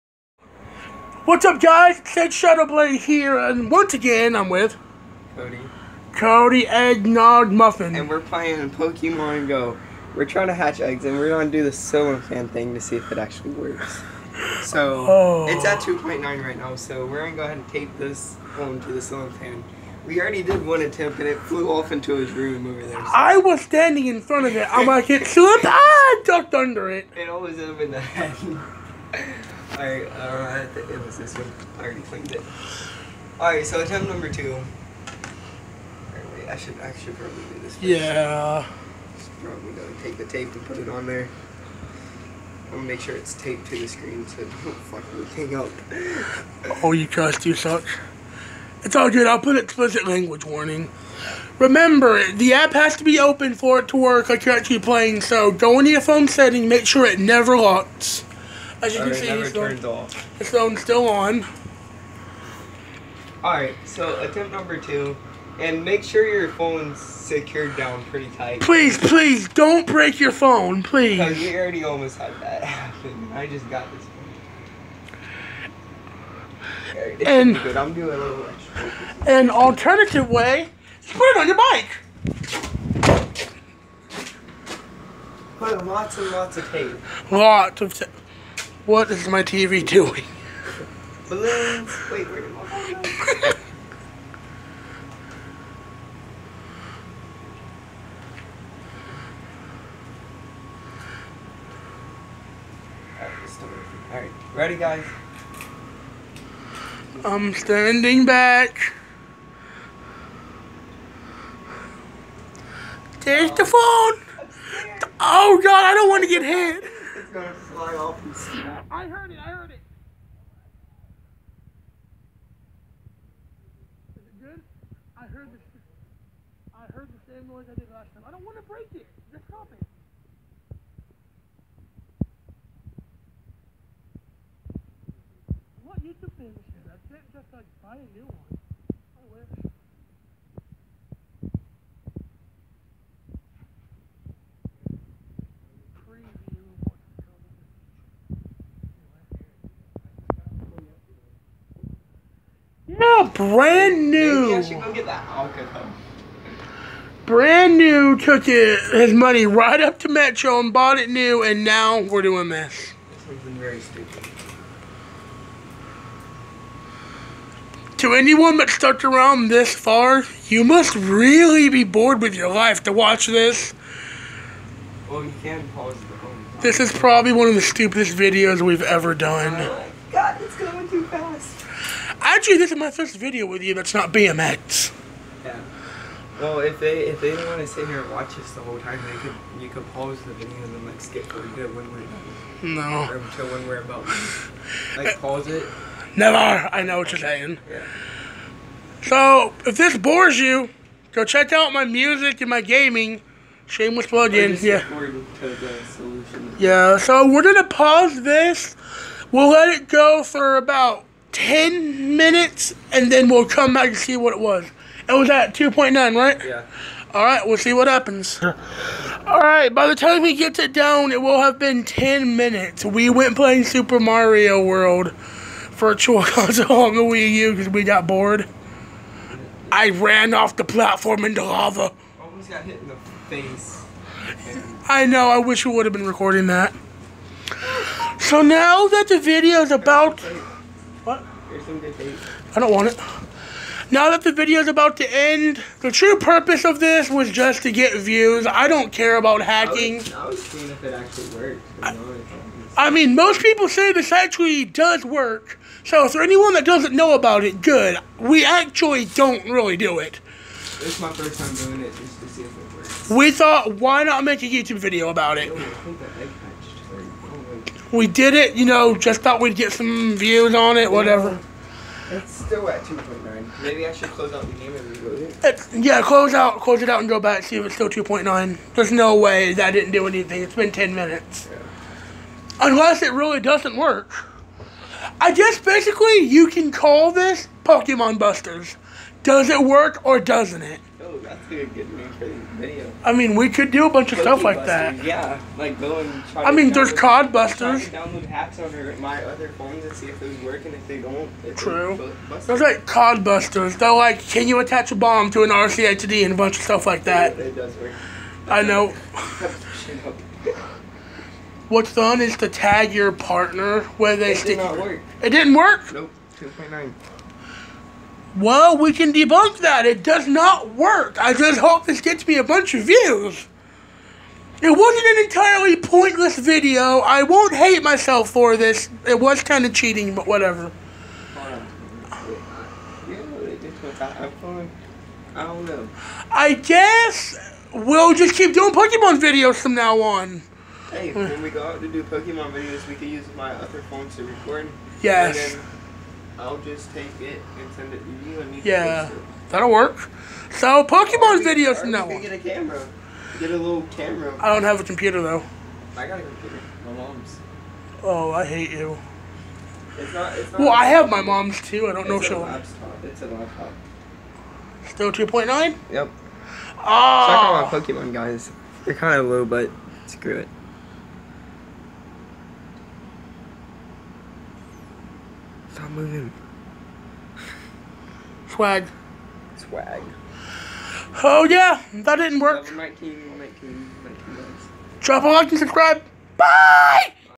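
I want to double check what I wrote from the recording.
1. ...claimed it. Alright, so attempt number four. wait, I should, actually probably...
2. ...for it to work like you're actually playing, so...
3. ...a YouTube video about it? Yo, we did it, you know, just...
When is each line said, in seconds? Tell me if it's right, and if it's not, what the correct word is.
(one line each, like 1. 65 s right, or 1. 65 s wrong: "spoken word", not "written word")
1. 32 s wrong: "two", not "four"
2. 53 s right
3. 264 s right.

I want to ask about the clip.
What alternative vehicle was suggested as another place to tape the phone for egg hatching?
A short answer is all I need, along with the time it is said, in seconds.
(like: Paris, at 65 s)
bike, at 81 s.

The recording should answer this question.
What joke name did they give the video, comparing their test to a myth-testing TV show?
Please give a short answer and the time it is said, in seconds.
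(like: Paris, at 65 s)
Pokemon Busters, at 287 s.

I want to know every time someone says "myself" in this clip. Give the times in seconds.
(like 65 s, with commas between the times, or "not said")
327 s.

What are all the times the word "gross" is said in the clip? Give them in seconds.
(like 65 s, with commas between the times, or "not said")
not said.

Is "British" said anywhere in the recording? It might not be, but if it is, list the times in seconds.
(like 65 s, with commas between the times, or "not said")
not said.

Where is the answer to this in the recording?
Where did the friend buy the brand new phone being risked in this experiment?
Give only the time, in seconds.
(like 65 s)
159 s.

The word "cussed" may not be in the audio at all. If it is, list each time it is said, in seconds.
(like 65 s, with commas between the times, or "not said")
47 s.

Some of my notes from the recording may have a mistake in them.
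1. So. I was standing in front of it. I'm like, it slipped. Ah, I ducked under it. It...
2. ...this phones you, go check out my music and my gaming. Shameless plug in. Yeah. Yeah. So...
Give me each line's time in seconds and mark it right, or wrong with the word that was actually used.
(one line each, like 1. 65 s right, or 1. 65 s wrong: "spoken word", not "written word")
1. 22 s right
2. 199 s wrong: "bores", not "phones".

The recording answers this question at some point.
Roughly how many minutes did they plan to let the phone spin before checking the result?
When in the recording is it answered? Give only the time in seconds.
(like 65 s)
210 s.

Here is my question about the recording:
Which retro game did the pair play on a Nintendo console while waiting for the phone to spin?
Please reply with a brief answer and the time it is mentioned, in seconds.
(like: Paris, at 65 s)
Super Mario World, at 223 s.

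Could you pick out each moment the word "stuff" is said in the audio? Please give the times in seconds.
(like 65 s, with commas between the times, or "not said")
294 s, 306 s.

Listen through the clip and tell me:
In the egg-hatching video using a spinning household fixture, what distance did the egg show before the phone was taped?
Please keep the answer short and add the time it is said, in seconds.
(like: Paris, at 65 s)
2.9, at 15 s.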